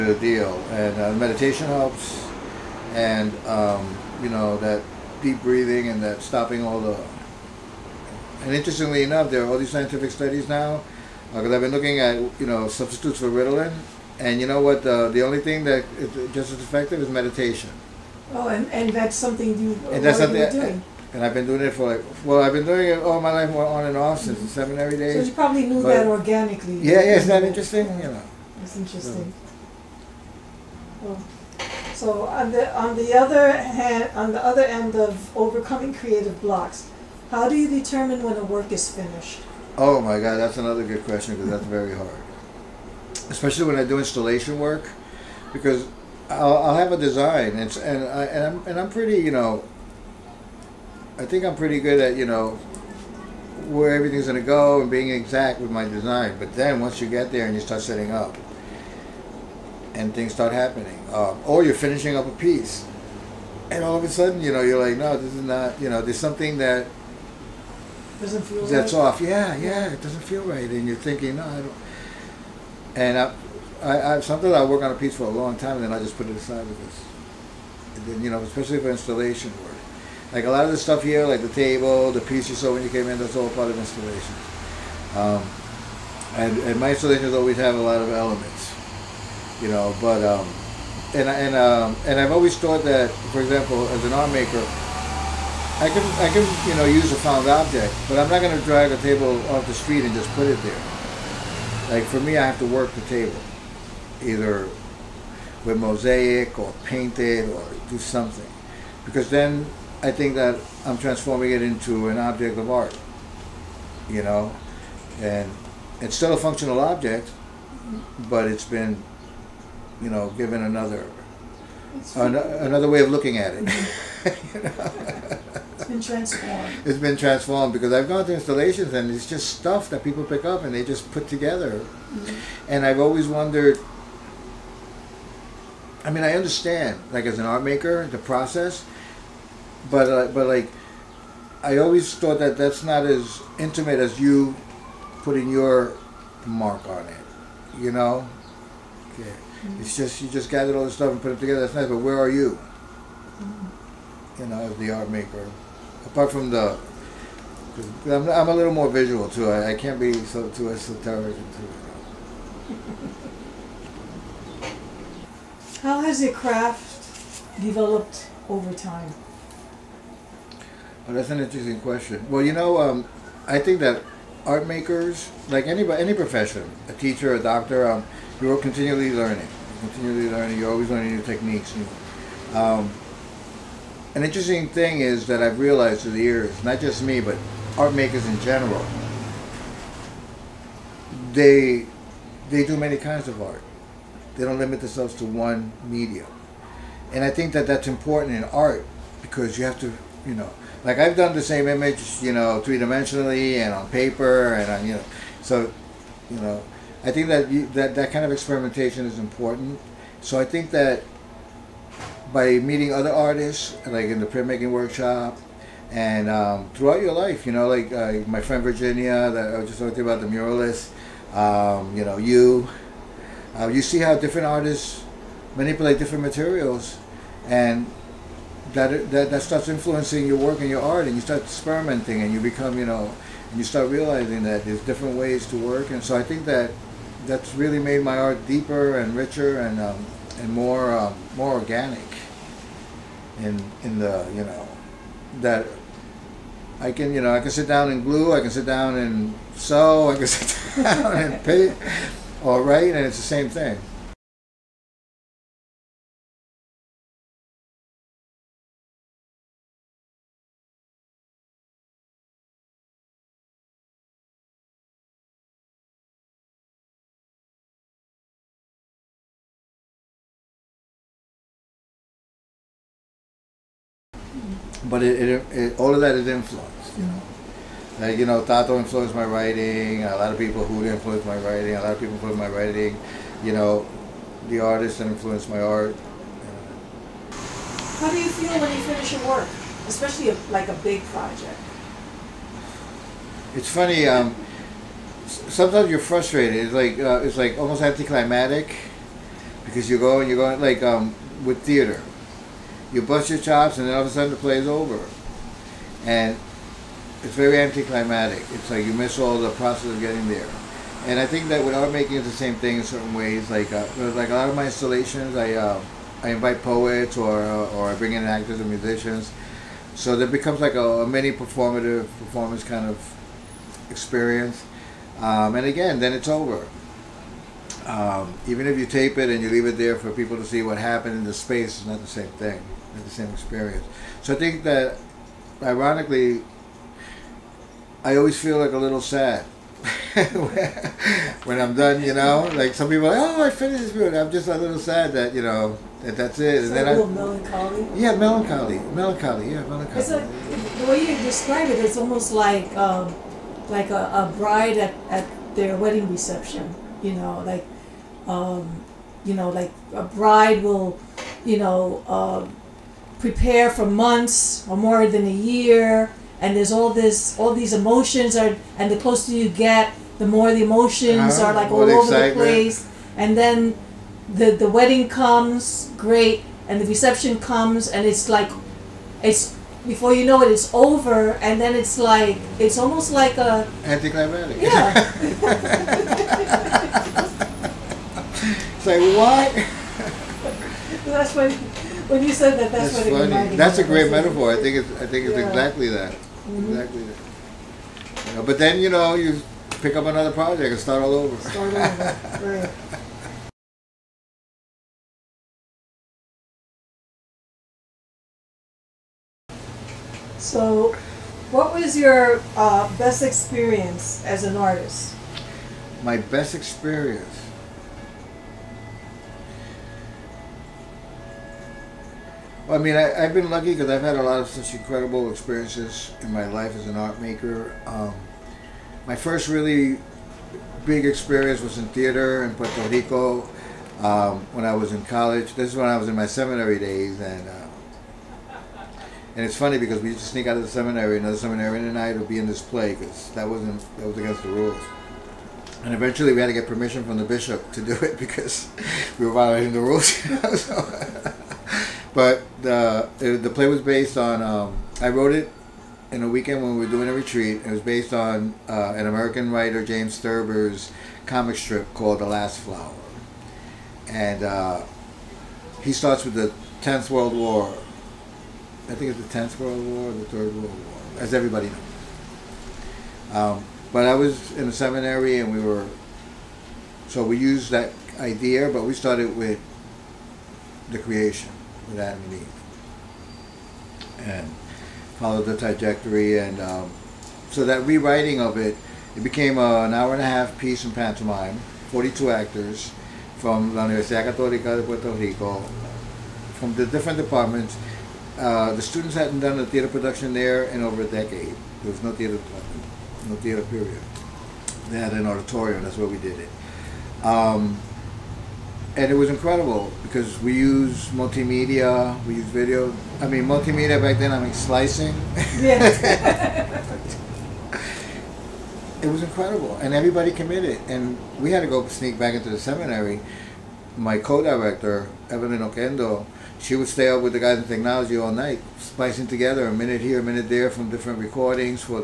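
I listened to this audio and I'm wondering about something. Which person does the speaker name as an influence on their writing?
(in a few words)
Tato.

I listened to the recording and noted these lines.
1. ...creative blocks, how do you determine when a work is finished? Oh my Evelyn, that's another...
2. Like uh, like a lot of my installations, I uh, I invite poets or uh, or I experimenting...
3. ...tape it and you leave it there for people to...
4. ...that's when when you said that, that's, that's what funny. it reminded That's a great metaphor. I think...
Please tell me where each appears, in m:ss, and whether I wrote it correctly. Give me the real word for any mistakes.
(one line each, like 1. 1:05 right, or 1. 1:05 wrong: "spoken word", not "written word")
1. 0:35 wrong: "God", not "Evelyn"
2. 5:13 wrong: "bring", not "experimenting"
3. 5:28 right
4. 6:31 right.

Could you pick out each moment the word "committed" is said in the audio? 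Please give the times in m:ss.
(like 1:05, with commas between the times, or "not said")
8:40.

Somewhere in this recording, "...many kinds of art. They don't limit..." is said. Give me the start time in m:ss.
3:12.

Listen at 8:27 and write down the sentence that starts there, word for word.
Um, and it was incredible because we use multimedia, we use video.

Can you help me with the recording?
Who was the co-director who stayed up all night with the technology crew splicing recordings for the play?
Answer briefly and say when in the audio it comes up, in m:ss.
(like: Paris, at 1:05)
Evelyn Oquendo, at 8:45.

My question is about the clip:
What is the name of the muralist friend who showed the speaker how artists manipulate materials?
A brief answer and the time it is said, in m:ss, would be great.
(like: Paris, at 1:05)
Virginia, at 3:38.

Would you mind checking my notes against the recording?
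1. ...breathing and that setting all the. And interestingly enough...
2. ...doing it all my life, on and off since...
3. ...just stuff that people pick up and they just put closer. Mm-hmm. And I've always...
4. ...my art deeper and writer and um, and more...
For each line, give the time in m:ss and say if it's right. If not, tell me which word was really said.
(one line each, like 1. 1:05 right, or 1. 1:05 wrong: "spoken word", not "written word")
1. 0:05 wrong: "stopping", not "setting"
2. 0:22 right
3. 2:09 wrong: "together", not "closer"
4. 3:58 wrong: "richer", not "writer".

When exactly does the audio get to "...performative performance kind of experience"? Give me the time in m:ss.
5:21.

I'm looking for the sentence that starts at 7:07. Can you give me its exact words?
Um, my first really big experience was in theater in Puerto Rico um, when I was in college.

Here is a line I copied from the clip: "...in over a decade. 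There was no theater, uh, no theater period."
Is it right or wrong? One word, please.
right.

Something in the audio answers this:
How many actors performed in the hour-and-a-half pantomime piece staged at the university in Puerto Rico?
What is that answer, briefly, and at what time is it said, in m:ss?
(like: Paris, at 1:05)
42, at 8:11.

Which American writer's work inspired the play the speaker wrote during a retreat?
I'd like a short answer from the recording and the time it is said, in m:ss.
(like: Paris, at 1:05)
James Thurber, at 7:39.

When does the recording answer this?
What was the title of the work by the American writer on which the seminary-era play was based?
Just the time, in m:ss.
7:42.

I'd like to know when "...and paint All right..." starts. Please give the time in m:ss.
4:11.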